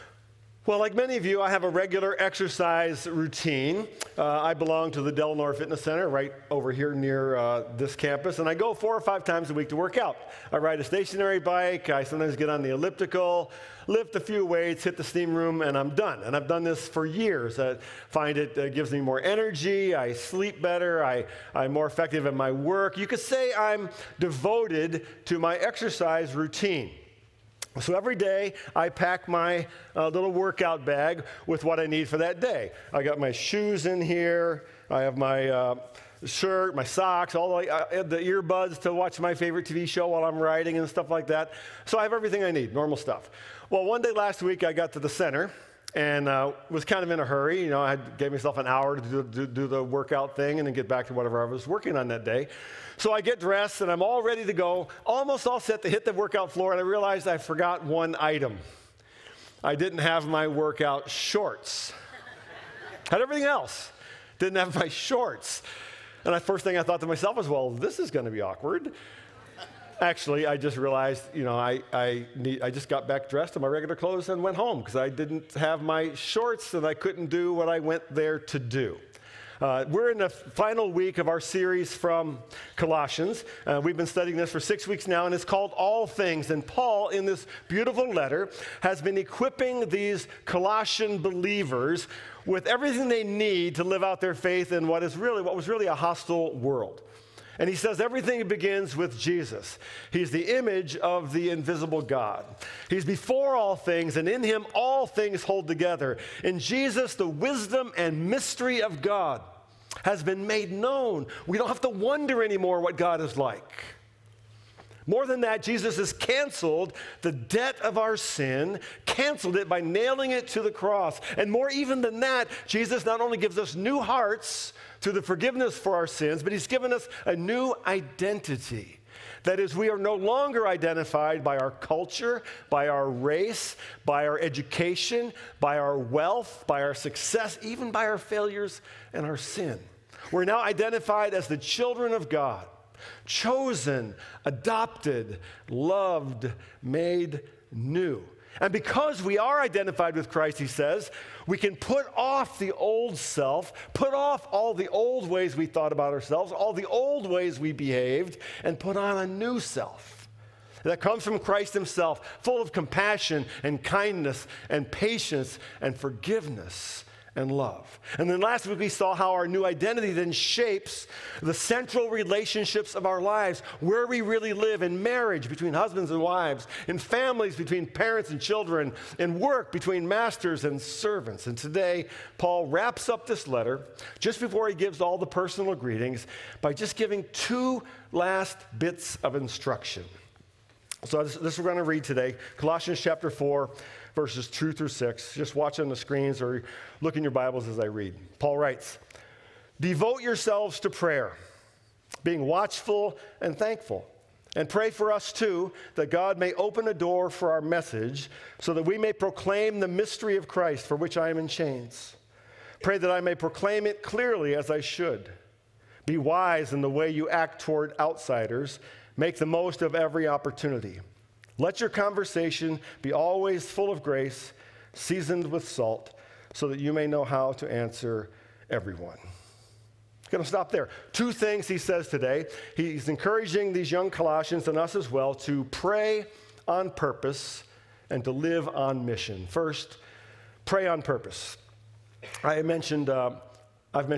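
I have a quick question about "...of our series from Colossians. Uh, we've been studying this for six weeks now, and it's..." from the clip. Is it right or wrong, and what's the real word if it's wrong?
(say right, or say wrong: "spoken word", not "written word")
right.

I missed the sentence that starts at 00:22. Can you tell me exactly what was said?
You could say I'm devoted to my exercise routine.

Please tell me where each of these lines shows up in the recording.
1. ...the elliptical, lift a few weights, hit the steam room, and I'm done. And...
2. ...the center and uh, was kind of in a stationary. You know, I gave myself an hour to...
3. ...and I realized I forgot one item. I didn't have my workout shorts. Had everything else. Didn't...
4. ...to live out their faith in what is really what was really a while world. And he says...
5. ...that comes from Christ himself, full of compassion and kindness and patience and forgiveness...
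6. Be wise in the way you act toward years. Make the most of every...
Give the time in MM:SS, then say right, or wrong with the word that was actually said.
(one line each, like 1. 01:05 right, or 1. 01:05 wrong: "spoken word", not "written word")
1. 00:12 right
2. 00:44 wrong: "hurry", not "stationary"
3. 00:56 right
4. 01:33 wrong: "hostile", not "while"
5. 02:40 right
6. 03:36 wrong: "outsiders", not "years".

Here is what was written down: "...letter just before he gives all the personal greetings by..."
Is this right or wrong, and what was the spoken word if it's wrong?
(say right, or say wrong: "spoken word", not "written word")
right.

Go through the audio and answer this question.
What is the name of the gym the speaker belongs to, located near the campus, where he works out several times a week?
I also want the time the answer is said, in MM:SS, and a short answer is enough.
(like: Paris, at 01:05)
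Delnor Fitness Center, at 00:05.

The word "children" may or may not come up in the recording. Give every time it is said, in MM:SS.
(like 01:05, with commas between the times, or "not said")
02:21, 02:58.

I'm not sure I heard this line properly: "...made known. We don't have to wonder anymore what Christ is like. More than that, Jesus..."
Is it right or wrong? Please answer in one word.
wrong.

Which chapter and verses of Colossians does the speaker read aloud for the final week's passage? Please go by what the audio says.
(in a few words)
Chapter 4 verses 2-6.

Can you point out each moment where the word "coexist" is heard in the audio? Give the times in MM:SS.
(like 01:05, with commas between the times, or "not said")
not said.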